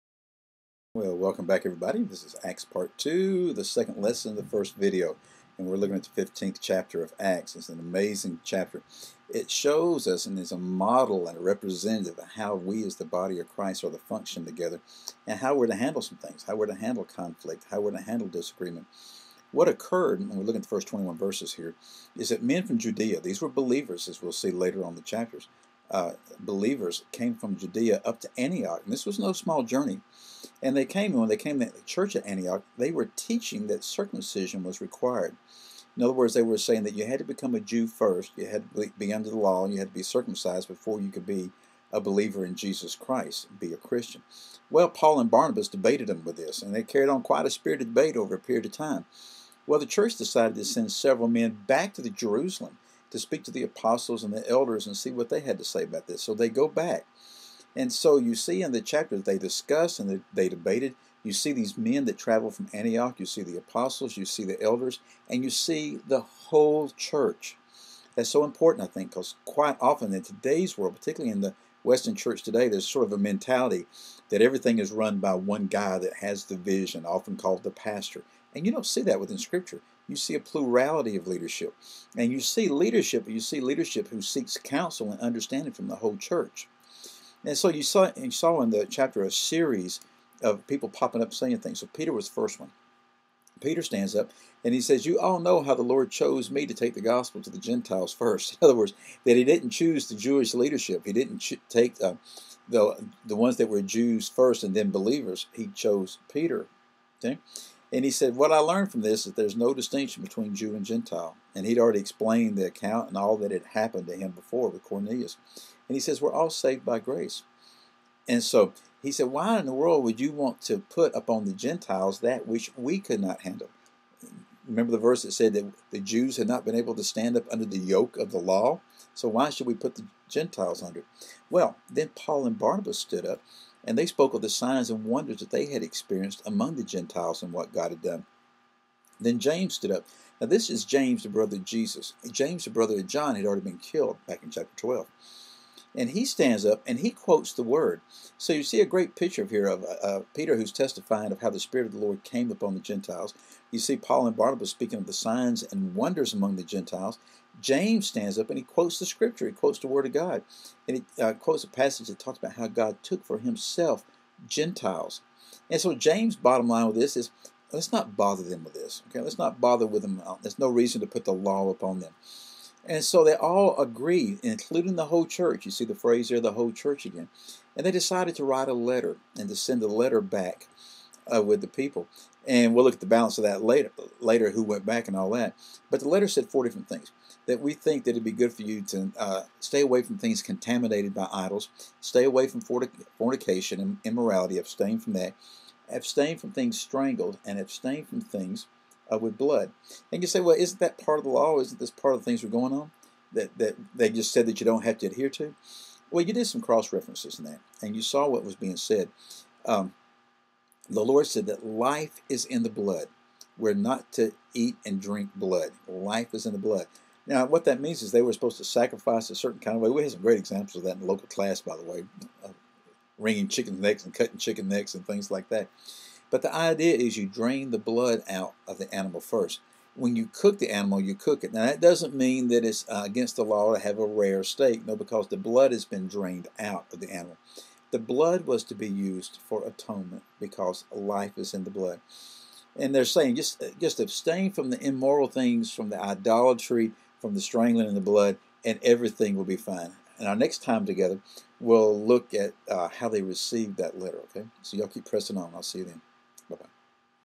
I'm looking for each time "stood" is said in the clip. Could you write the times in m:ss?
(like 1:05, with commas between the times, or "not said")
2:12, 2:19.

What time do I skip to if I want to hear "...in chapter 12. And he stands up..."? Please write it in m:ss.
2:24.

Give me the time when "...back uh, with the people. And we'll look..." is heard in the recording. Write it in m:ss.
3:00.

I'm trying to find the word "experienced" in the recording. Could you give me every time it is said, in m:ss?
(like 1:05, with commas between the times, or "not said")
2:15.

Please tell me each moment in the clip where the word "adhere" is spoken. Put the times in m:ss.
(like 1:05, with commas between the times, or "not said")
3:25.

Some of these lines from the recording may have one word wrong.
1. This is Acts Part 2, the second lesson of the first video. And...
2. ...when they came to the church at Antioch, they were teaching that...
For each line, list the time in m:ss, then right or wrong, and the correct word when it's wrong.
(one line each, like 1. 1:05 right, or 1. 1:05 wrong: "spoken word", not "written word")
1. 0:02 right
2. 0:31 right.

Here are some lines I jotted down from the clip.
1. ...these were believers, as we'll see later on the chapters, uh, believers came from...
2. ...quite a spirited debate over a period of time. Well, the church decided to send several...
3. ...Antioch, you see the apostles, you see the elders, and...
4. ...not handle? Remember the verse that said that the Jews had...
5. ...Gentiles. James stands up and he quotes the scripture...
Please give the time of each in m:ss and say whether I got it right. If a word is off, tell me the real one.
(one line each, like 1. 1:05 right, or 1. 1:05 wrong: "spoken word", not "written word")
1. 0:23 right
2. 0:47 right
3. 1:02 right
4. 2:03 right
5. 2:36 right.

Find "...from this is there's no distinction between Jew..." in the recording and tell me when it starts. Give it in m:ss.
1:48.